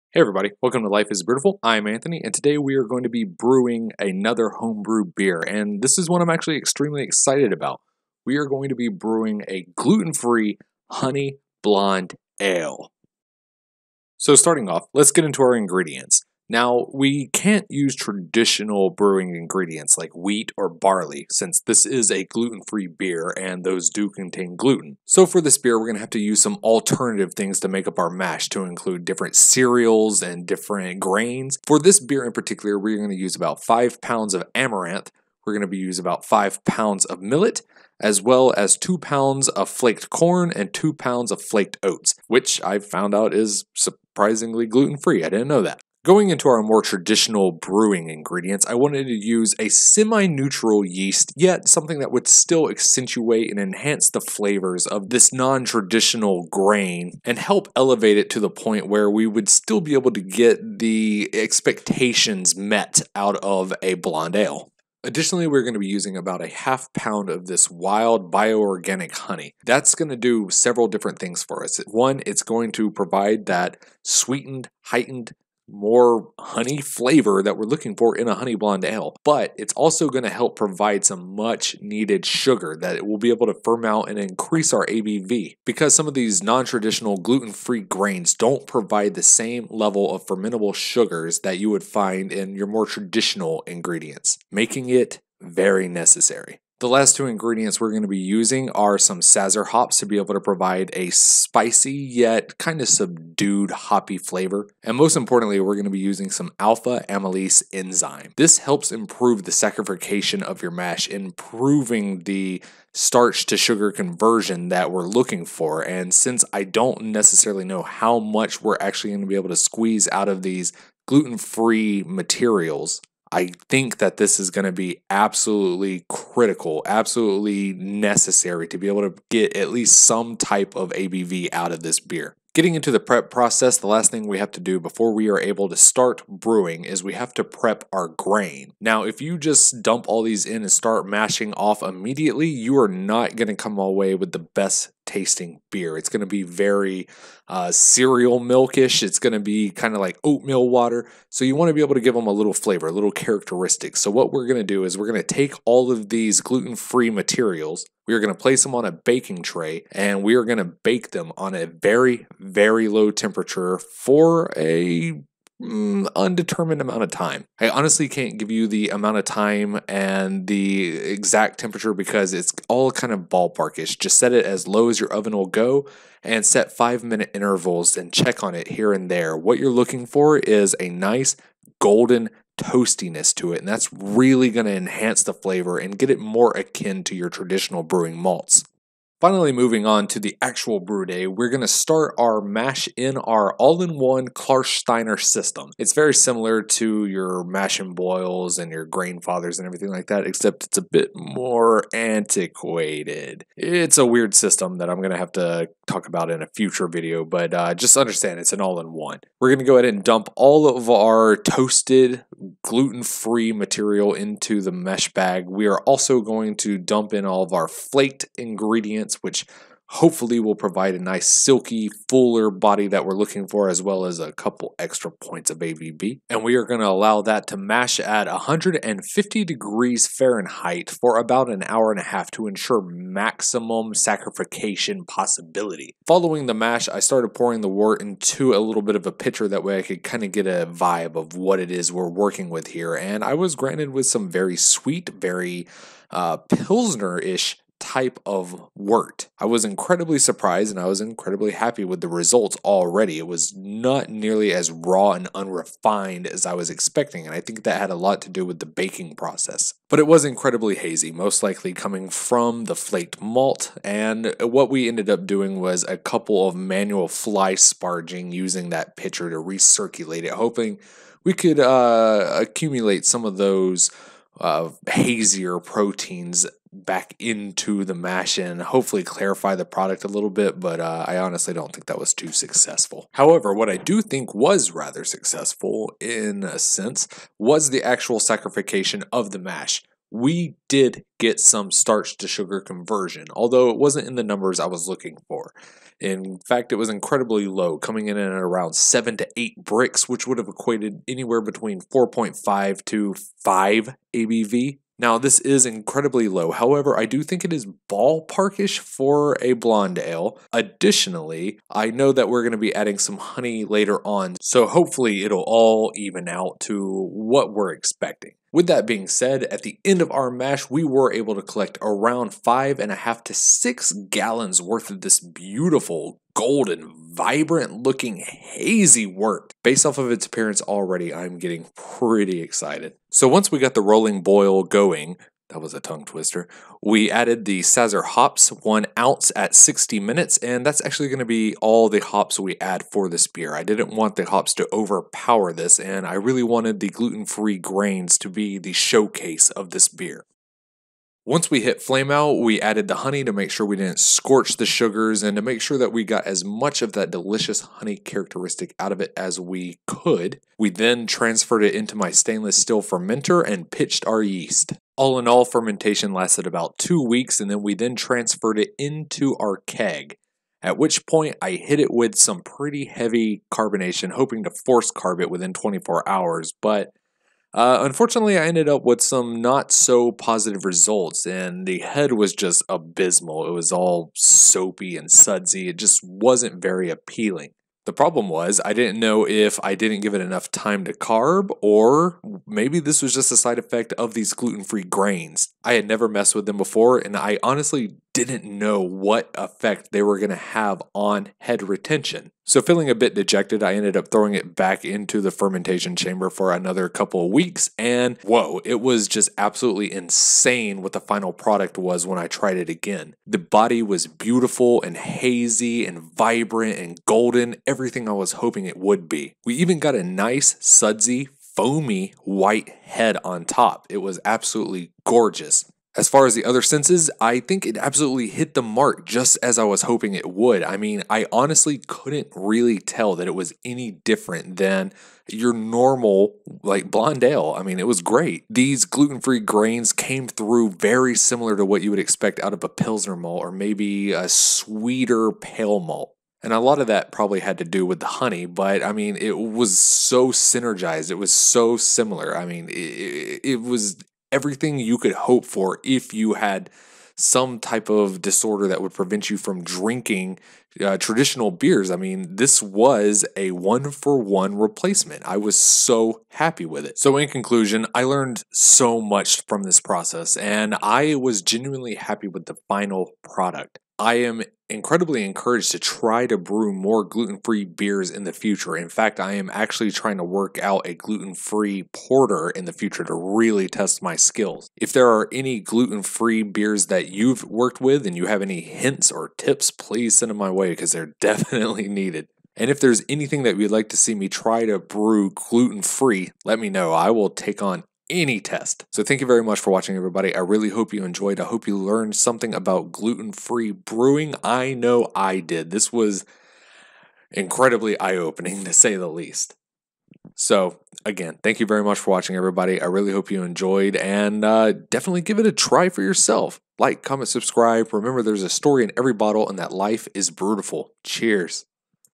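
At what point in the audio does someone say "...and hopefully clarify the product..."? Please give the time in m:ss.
4:38.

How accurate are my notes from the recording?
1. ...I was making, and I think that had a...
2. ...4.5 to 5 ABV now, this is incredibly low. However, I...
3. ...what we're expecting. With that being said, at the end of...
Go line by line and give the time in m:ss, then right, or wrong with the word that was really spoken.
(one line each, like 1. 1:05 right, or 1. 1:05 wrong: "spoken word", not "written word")
1. 4:16 wrong: "expecting", not "making"
2. 5:01 right
3. 5:17 right.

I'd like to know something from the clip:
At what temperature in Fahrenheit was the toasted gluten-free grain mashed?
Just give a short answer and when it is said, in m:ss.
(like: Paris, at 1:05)
150 degrees, at 3:48.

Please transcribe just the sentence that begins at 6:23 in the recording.
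It was all soapy and sudsy.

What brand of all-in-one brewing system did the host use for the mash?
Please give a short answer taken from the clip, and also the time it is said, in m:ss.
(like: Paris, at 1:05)
Klarsteiner, at 3:14.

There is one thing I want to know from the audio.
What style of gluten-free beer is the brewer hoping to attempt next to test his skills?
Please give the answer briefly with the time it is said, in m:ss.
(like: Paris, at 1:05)
Porter, at 8:01.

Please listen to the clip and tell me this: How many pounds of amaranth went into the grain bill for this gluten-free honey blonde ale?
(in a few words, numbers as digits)
5 pounds.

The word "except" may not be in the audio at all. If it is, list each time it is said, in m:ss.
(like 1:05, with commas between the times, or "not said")
3:20.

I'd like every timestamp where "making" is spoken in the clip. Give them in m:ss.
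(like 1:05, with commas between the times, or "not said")
1:34.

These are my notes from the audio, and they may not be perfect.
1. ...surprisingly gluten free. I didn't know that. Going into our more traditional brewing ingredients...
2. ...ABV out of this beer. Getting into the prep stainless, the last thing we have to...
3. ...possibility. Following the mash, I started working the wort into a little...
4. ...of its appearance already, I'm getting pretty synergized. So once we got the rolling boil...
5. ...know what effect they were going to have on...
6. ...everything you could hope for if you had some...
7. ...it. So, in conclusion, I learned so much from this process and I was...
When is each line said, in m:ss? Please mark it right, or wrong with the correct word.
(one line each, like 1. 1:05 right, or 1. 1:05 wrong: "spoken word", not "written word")
1. 0:43 right
2. 2:10 wrong: "process", not "stainless"
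3. 3:55 wrong: "pouring", not "working"
4. 5:29 wrong: "excited", not "synergized"
5. 6:38 right
6. 7:34 right
7. 7:46 right.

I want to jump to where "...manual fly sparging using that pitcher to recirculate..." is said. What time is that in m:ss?
4:26.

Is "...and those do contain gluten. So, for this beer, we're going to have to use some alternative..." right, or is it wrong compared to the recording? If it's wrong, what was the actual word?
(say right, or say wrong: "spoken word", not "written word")
right.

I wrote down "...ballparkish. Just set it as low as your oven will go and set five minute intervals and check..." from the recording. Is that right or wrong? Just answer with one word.
right.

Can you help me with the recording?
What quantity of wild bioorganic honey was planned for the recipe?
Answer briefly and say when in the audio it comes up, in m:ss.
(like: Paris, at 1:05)
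Half pound, at 1:06.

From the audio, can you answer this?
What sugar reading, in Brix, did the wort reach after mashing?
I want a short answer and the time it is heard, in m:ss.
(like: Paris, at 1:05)
7 to 8, at 4:58.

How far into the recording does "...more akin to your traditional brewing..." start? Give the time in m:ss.
3:06.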